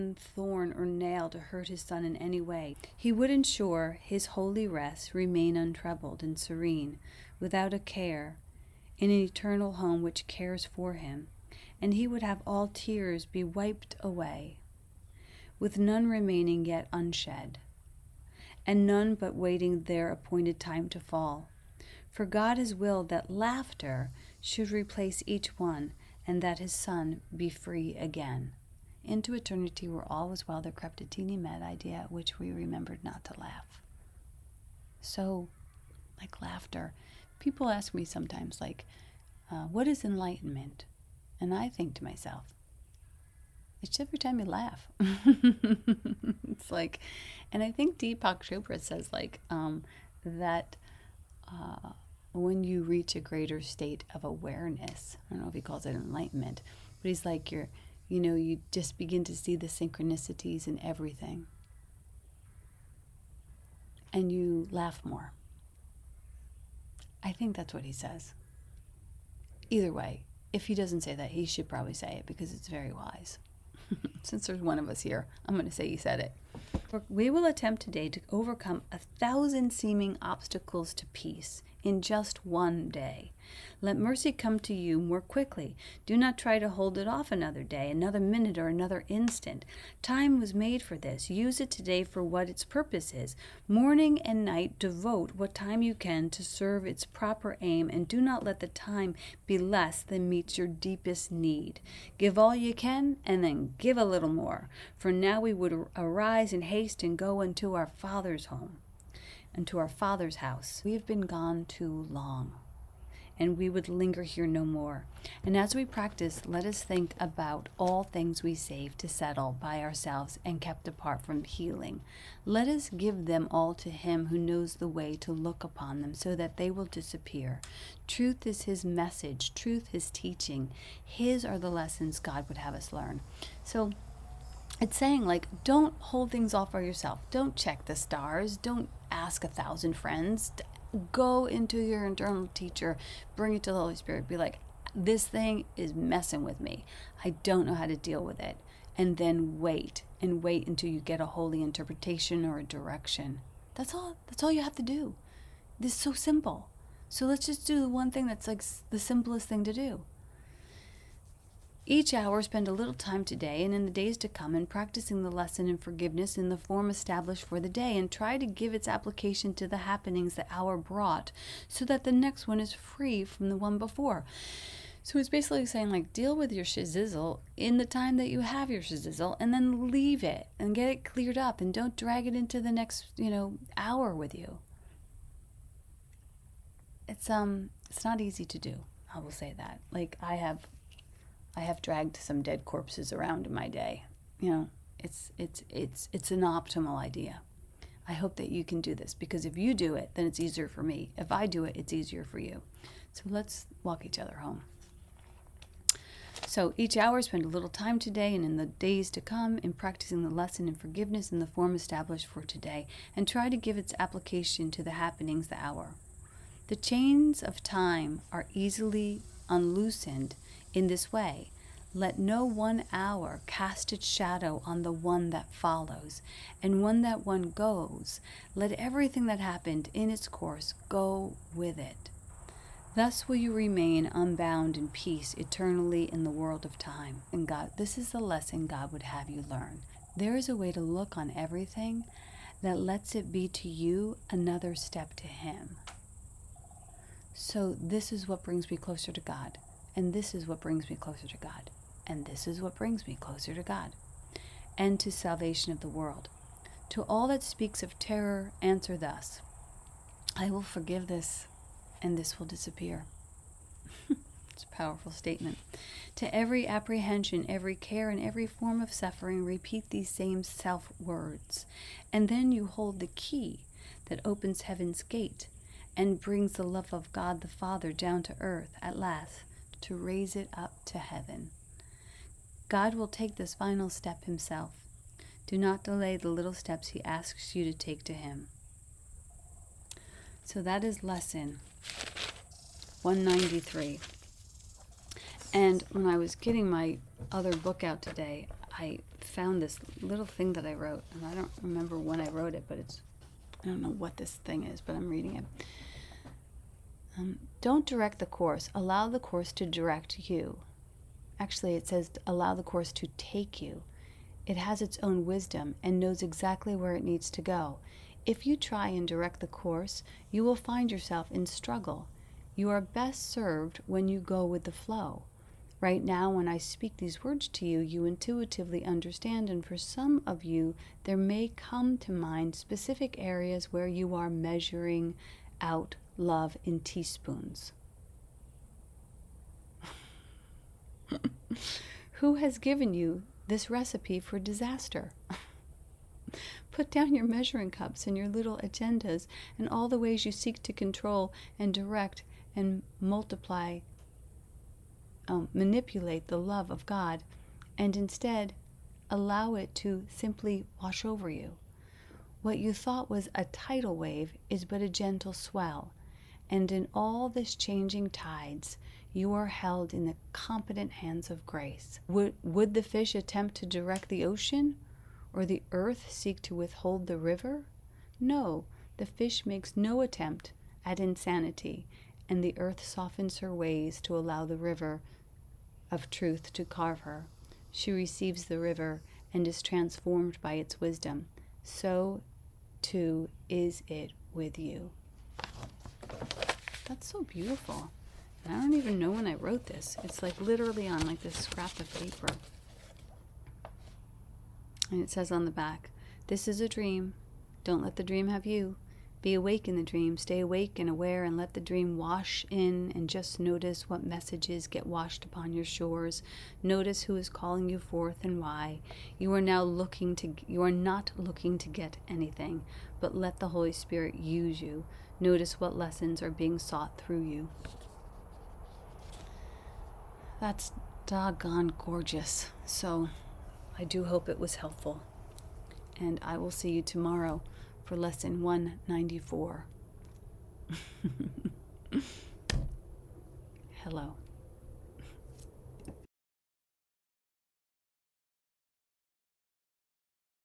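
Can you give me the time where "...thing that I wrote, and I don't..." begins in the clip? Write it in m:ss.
5:00.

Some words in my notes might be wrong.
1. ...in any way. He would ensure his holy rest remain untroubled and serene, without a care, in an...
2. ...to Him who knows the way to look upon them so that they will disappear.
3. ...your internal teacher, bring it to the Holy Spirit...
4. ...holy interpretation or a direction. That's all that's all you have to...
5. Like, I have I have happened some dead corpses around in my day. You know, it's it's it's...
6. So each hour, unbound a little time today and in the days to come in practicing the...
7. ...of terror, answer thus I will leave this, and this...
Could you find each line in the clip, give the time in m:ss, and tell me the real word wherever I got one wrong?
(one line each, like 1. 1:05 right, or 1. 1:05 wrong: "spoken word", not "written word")
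1. 0:02 right
2. 2:03 right
3. 2:21 right
4. 2:31 right
5. 3:09 wrong: "dragged", not "happened"
6. 3:26 wrong: "spend", not "unbound"
7. 4:17 wrong: "forgive", not "leave".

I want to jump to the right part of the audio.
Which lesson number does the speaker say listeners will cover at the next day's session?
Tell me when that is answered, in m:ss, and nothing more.
7:18.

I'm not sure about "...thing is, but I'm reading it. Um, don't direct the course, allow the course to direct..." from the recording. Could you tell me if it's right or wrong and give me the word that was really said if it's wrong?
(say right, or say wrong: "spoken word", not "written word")
right.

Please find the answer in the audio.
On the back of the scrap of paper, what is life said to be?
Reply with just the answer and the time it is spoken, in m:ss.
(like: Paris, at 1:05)
a dream, at 6:46.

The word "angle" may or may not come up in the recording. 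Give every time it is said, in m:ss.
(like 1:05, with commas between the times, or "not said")
not said.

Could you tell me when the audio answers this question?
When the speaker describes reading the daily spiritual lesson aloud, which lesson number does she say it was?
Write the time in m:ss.
4:53.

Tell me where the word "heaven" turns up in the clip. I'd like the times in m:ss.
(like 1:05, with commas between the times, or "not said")
4:34, 4:40.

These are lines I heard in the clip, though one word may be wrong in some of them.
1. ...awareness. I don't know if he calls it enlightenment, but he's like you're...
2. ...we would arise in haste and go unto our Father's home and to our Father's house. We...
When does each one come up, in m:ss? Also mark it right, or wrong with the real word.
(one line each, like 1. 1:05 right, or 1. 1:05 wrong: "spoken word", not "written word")
1. 0:54 right
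2. 1:45 right.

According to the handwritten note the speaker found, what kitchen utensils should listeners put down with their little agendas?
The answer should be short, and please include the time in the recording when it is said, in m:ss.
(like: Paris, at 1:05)
measuring cups, at 5:47.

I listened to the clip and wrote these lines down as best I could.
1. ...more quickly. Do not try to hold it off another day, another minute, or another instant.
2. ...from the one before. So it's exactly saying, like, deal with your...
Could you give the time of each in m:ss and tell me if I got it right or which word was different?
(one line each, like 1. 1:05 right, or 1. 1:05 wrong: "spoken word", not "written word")
1. 1:24 right
2. 2:53 wrong: "basically", not "exactly".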